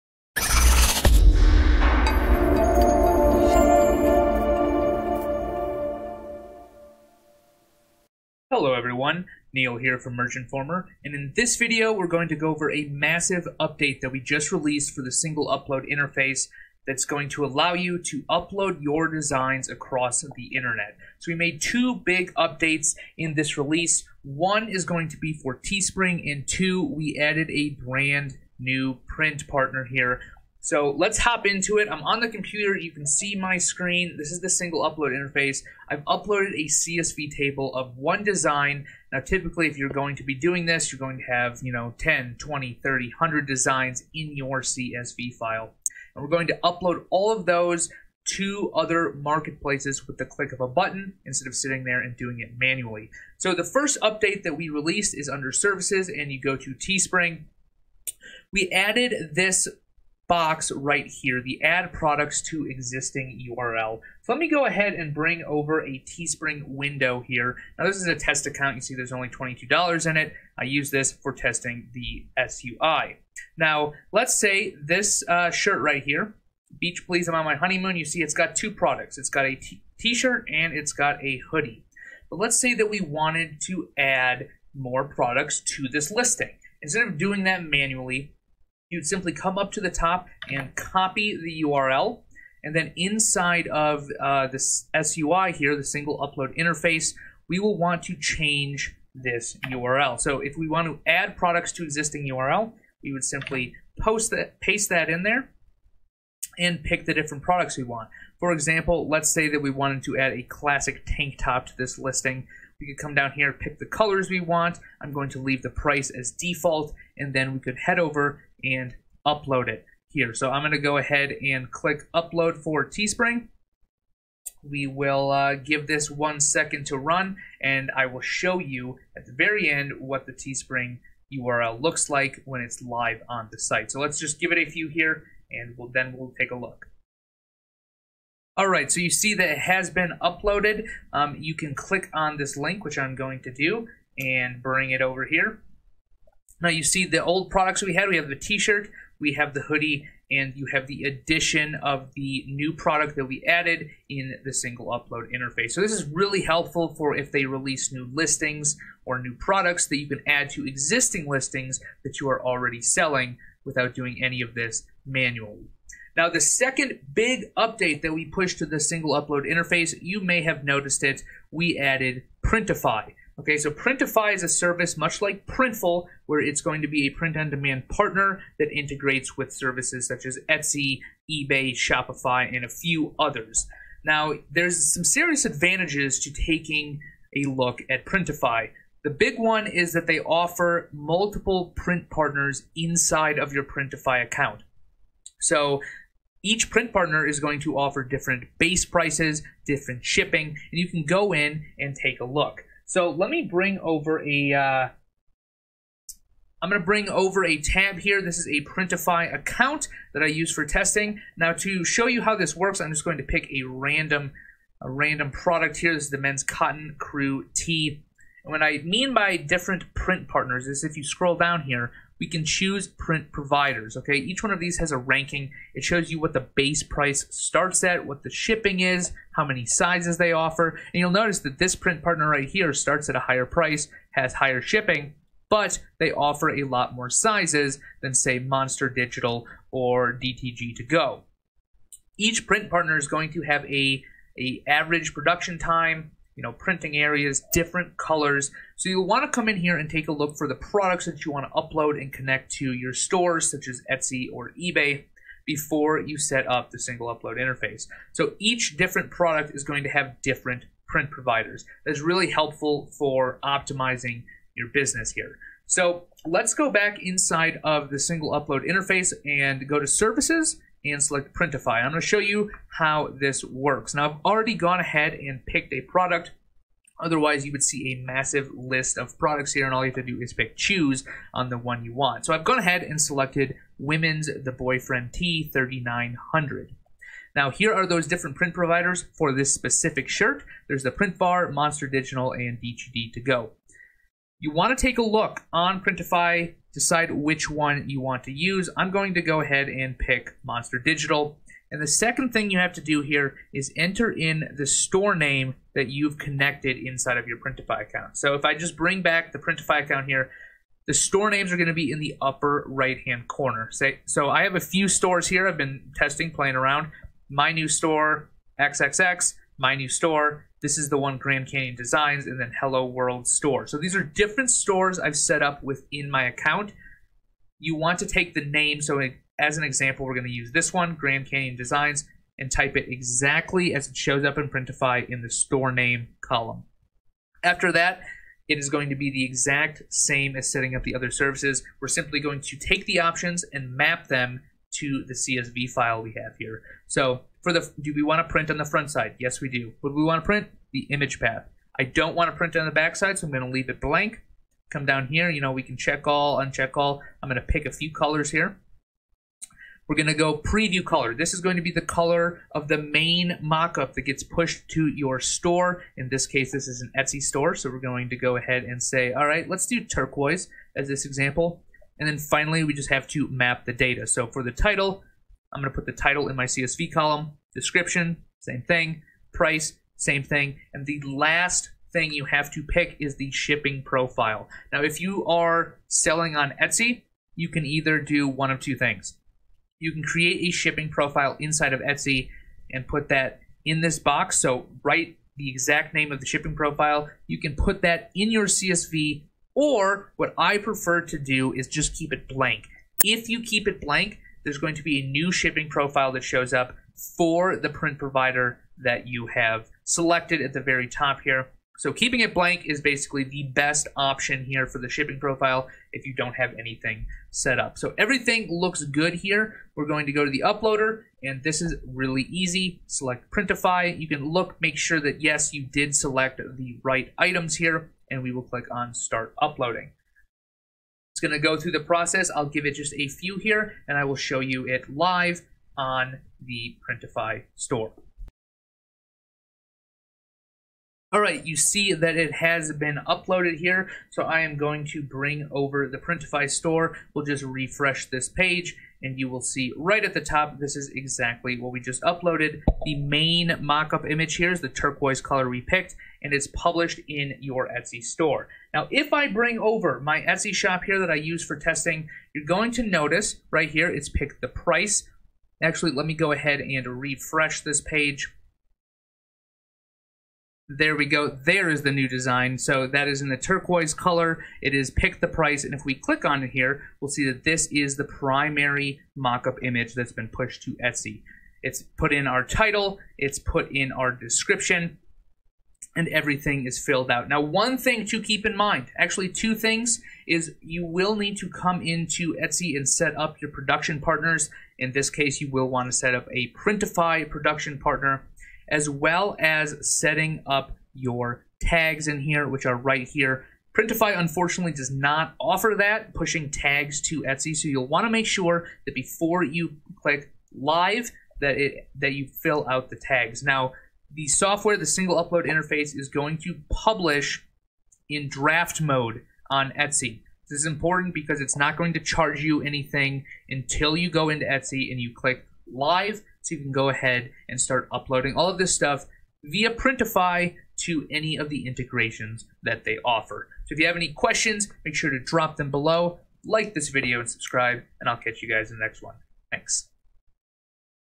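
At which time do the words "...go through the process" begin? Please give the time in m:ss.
7:11.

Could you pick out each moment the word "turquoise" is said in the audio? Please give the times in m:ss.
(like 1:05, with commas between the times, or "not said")
6:09, 7:34, 7:53.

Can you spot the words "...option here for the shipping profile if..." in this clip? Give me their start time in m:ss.
6:53.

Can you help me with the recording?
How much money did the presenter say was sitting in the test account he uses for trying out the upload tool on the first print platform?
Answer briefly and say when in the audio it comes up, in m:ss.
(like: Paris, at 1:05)
$22, at 1:09.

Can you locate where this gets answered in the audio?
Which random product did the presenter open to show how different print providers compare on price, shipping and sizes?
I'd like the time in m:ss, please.
3:36.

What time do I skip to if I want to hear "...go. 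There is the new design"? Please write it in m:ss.
7:51.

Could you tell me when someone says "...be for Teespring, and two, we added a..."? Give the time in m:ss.
0:25.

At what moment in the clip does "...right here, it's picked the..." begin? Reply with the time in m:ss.
7:43.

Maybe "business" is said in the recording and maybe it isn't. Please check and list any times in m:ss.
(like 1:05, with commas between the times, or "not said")
4:24.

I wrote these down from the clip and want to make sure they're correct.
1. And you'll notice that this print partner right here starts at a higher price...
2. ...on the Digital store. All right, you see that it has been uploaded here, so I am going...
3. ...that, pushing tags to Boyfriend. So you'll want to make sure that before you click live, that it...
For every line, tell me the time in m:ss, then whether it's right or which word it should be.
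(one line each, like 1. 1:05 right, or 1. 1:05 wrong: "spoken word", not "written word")
1. 3:50 right
2. 7:15 wrong: "Printify", not "Digital"
3. 8:25 wrong: "Etsy", not "Boyfriend".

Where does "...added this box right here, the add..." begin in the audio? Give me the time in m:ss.
0:58.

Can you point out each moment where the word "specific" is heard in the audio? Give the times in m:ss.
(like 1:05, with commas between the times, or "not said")
4:49.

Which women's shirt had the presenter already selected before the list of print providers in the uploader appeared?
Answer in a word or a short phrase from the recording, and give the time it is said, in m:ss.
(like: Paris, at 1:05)
Women's The Boyfriend T 3900, at 4:43.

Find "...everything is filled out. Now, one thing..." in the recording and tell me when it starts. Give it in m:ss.
8:06.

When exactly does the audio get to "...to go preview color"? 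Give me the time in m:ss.
6:00.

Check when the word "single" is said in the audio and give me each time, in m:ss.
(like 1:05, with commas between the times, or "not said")
0:15, 0:34, 1:35, 2:34, 2:48, 4:16, 4:27, 8:34.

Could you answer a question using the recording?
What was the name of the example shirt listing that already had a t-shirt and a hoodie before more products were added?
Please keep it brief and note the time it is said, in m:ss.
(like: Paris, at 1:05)
Beach Please, at 1:16.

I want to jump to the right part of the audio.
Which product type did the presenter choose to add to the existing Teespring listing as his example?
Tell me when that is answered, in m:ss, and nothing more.
1:50.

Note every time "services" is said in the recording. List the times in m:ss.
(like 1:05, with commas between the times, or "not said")
0:55, 2:54, 2:59, 4:29, 5:41.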